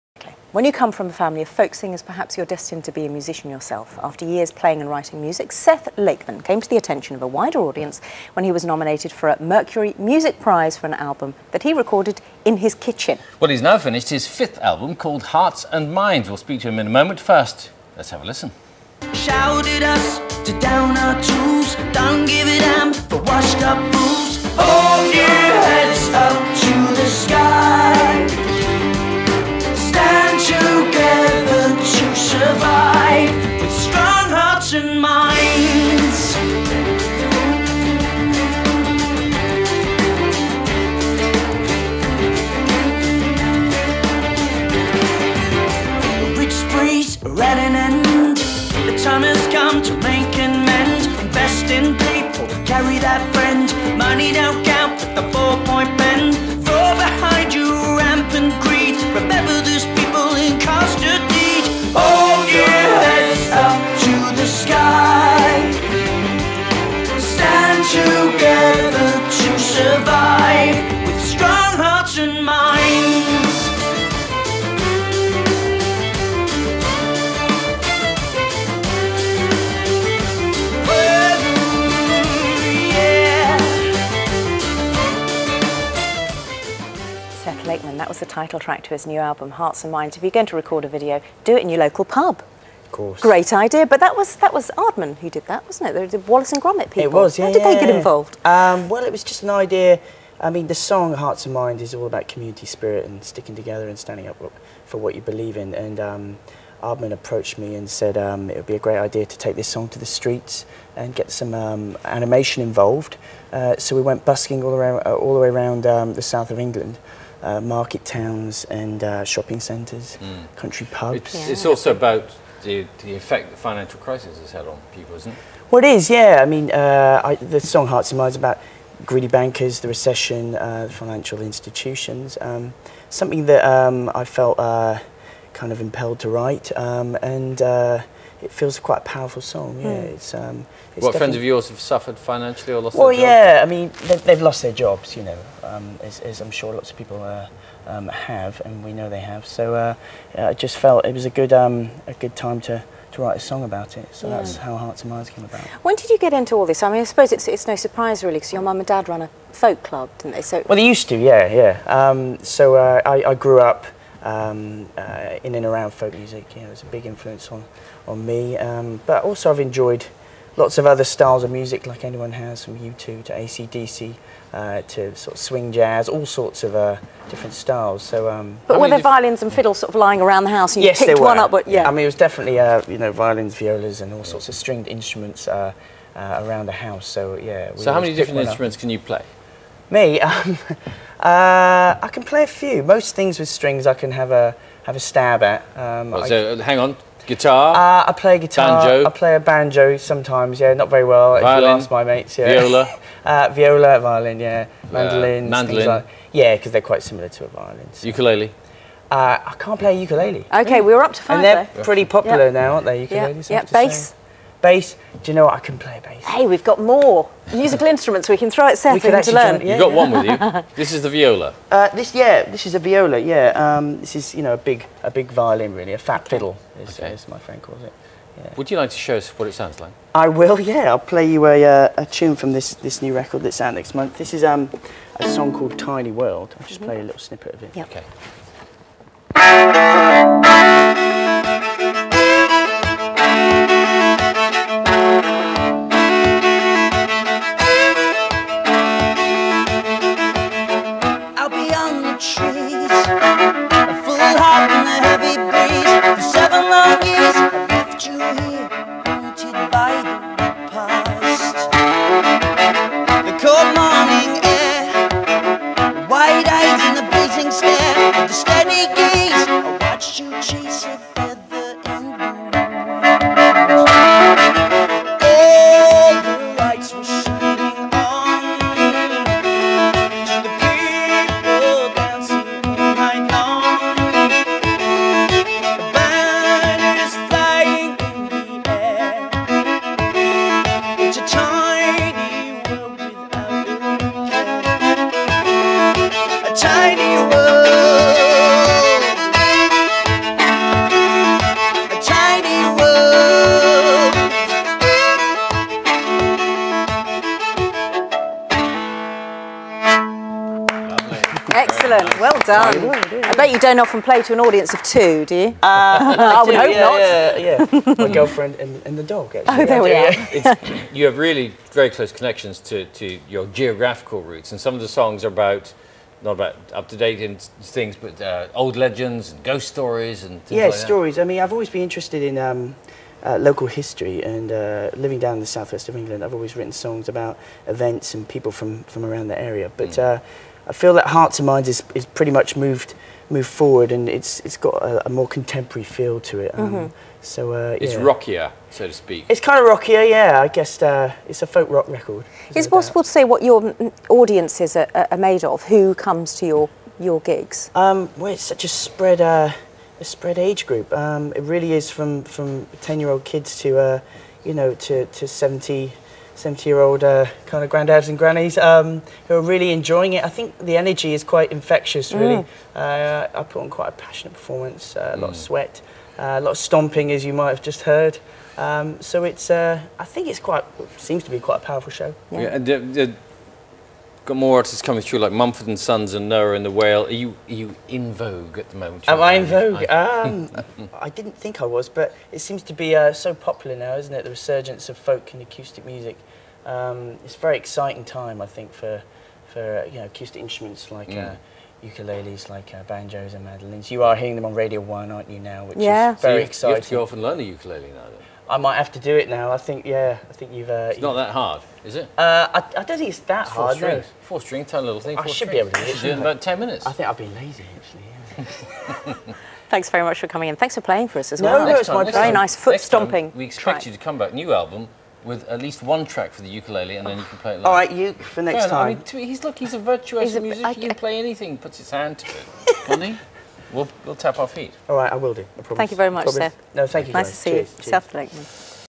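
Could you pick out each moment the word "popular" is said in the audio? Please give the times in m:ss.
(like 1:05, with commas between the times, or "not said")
3:32, 6:33.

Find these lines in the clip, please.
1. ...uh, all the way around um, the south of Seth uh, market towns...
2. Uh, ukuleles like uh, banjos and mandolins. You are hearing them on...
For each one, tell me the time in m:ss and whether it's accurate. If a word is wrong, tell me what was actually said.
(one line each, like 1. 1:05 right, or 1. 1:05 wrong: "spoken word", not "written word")
1. 1:55 wrong: "England", not "Seth"
2. 6:41 right.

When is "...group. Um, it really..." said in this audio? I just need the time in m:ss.
6:00.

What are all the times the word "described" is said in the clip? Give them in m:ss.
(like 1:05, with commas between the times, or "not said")
not said.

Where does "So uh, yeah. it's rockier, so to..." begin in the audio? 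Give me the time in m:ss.
5:47.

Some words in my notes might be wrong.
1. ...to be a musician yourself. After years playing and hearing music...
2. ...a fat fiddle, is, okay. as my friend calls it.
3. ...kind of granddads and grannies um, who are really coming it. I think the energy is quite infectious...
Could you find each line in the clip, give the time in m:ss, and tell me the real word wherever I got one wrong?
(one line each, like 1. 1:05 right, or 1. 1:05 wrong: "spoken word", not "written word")
1. 0:02 wrong: "writing", not "hearing"
2. 3:45 right
3. 6:07 wrong: "enjoying", not "coming".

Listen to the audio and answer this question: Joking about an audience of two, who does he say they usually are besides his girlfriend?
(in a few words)
the dog.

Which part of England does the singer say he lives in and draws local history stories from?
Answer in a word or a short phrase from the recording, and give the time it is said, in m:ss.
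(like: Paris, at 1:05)
the southwest of England, at 5:35.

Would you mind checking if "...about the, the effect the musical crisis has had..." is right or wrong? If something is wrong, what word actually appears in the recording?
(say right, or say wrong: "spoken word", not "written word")
wrong: "financial", not "musical".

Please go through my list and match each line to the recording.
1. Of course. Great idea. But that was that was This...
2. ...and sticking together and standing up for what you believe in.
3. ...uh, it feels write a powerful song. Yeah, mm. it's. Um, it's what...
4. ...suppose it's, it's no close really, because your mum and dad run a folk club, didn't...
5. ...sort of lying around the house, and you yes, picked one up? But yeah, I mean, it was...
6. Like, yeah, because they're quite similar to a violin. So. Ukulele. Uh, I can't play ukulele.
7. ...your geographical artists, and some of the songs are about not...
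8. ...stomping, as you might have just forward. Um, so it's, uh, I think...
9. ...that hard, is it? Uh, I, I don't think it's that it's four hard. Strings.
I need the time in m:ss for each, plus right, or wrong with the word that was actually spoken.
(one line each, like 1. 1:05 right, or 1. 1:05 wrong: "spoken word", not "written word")
1. 1:32 wrong: "Aardman", not "This"
2. 1:43 right
3. 2:17 wrong: "quite", not "write"
4. 2:37 wrong: "surprise", not "close"
5. 2:59 right
6. 3:25 right
7. 5:23 wrong: "roots", not "artists"
8. 6:16 wrong: "heard", not "forward"
9. 6:51 right.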